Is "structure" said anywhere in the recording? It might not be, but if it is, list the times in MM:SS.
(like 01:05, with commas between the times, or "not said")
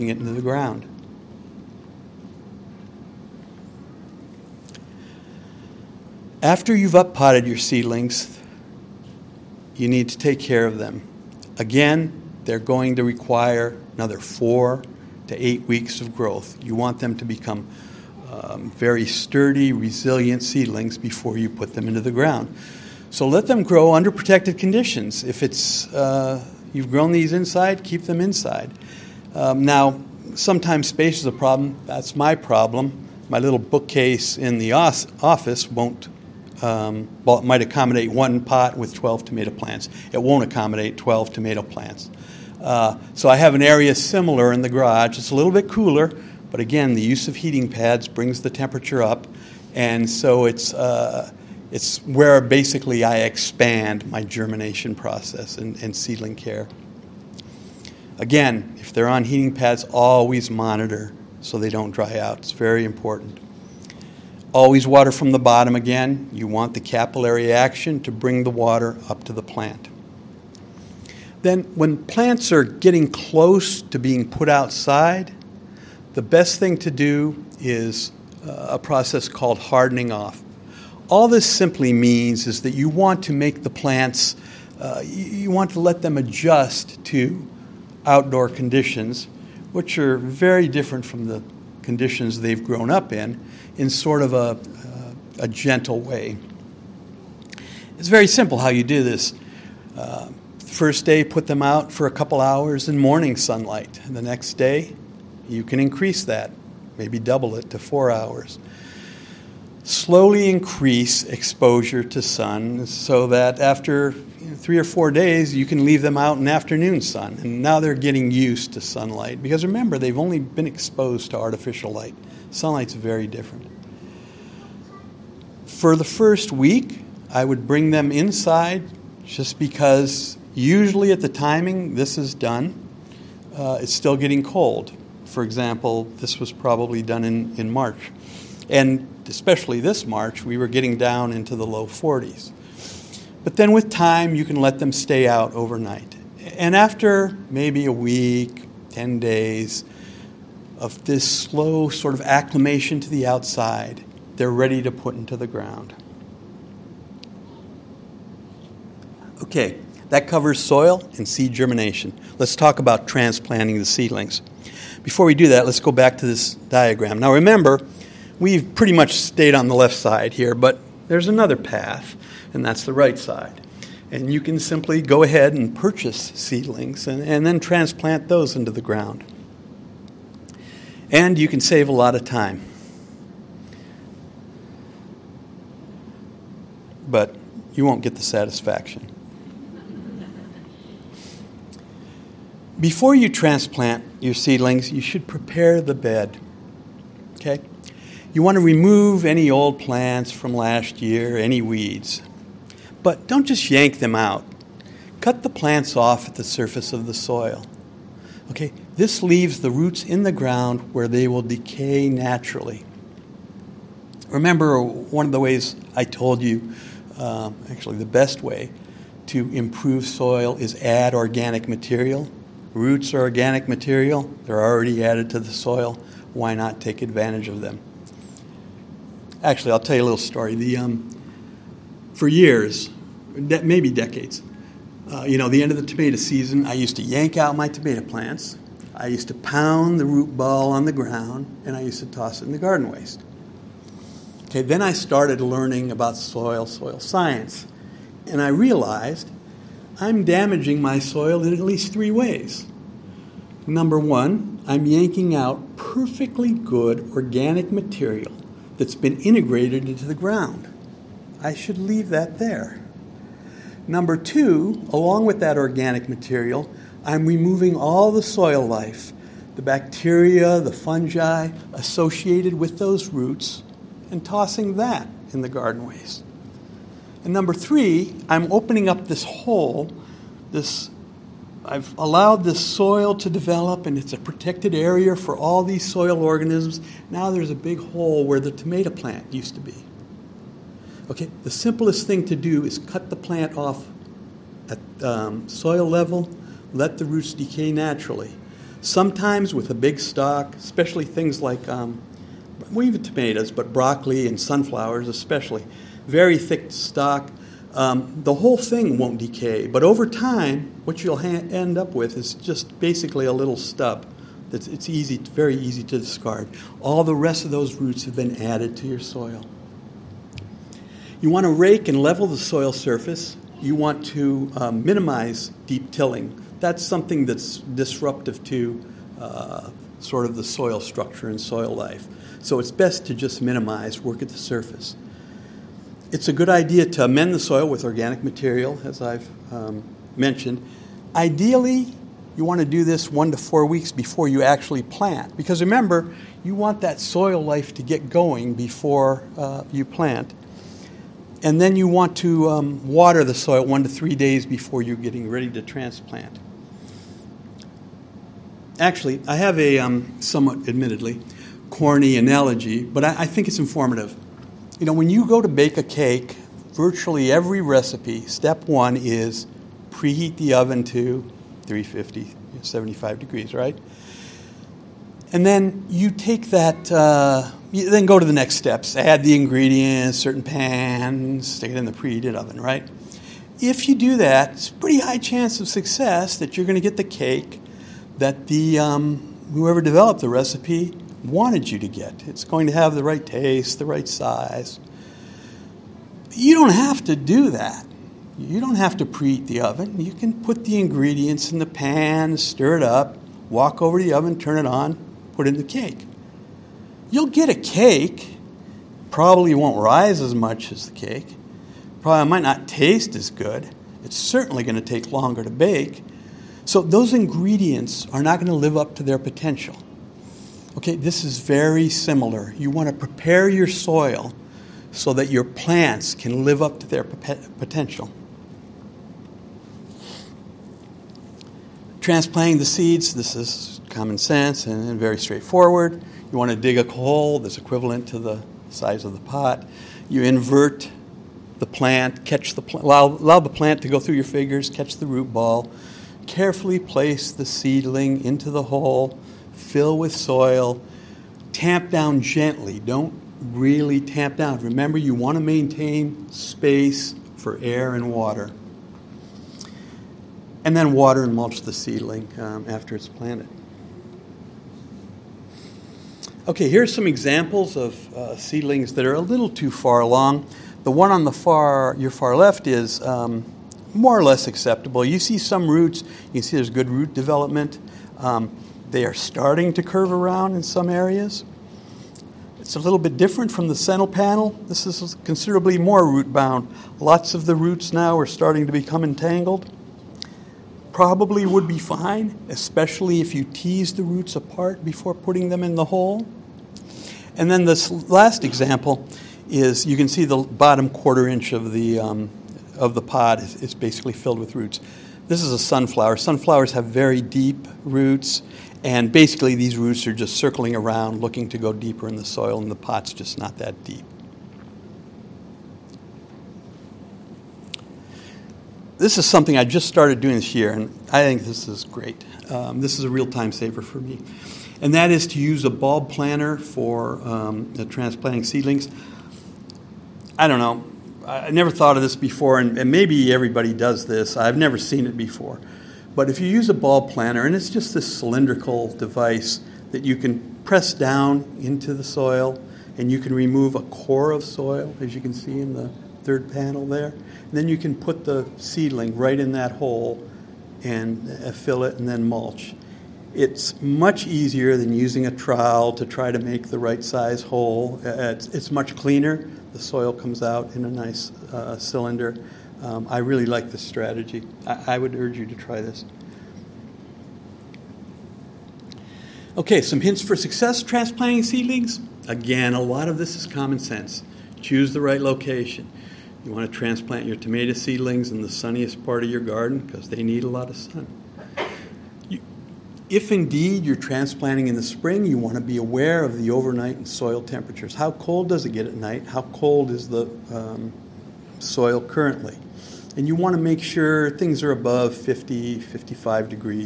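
05:30.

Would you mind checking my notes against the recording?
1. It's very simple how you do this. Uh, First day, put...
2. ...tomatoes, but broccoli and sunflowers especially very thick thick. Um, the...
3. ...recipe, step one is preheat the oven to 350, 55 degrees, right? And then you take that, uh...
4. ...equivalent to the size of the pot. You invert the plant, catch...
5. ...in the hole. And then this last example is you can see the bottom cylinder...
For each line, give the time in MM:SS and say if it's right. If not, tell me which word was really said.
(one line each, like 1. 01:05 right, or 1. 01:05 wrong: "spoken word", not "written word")
1. 01:37 right
2. 05:03 wrong: "stock", not "thick"
3. 06:07 wrong: "75", not "55"
4. 07:17 right
5. 08:15 wrong: "quarter", not "cylinder".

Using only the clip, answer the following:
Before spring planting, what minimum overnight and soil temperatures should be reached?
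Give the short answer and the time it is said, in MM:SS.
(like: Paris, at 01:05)
50 to 55, at 09:55.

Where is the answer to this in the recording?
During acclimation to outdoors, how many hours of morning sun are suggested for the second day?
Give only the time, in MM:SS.
01:47.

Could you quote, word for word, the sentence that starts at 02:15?
For example, this was probably done in, in March.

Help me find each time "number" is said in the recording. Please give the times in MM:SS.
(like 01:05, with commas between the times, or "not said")
04:13, 04:23, 04:37.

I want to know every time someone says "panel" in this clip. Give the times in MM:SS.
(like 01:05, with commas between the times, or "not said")
08:04, 09:06.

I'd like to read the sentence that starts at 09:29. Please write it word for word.
Okay, some hints for success transplanting seedlings.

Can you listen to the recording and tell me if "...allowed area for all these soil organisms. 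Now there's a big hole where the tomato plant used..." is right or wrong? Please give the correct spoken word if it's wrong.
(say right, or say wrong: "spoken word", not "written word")
wrong: "protected", not "allowed".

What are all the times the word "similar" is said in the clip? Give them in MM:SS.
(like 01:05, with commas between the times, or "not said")
00:43, 07:01.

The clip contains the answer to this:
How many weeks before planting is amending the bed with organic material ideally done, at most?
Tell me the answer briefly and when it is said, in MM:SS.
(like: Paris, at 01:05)
4 weeks, at 05:43.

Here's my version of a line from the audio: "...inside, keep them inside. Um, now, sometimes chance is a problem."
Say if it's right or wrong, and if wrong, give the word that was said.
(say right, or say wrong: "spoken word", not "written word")
wrong: "space", not "chance".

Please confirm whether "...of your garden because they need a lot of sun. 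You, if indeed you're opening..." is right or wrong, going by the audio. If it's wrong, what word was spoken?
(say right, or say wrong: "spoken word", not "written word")
wrong: "transplanting", not "opening".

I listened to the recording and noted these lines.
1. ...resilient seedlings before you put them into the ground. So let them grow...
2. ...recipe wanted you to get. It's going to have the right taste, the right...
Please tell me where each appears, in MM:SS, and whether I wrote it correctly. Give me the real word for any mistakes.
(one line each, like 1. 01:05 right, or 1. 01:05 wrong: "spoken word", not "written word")
1. 00:19 right
2. 06:30 right.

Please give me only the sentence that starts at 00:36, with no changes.
Um, well, it might accommodate one pot with 12 tomato plants.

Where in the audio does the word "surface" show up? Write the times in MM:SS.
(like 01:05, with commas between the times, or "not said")
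03:26, 05:22, 05:34.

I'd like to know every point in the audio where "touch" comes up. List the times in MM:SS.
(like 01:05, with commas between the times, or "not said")
not said.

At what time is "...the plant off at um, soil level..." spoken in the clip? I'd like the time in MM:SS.
04:53.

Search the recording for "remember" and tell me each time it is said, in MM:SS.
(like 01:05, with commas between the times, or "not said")
01:59, 02:47, 03:34, 05:45, 07:34.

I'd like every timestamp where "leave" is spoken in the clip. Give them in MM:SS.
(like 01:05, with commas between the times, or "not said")
01:55, 03:29, 04:21.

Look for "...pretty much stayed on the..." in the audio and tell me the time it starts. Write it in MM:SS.
02:48.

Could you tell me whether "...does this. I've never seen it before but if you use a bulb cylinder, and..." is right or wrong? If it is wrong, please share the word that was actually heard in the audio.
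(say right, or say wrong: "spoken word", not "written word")
wrong: "planter", not "cylinder".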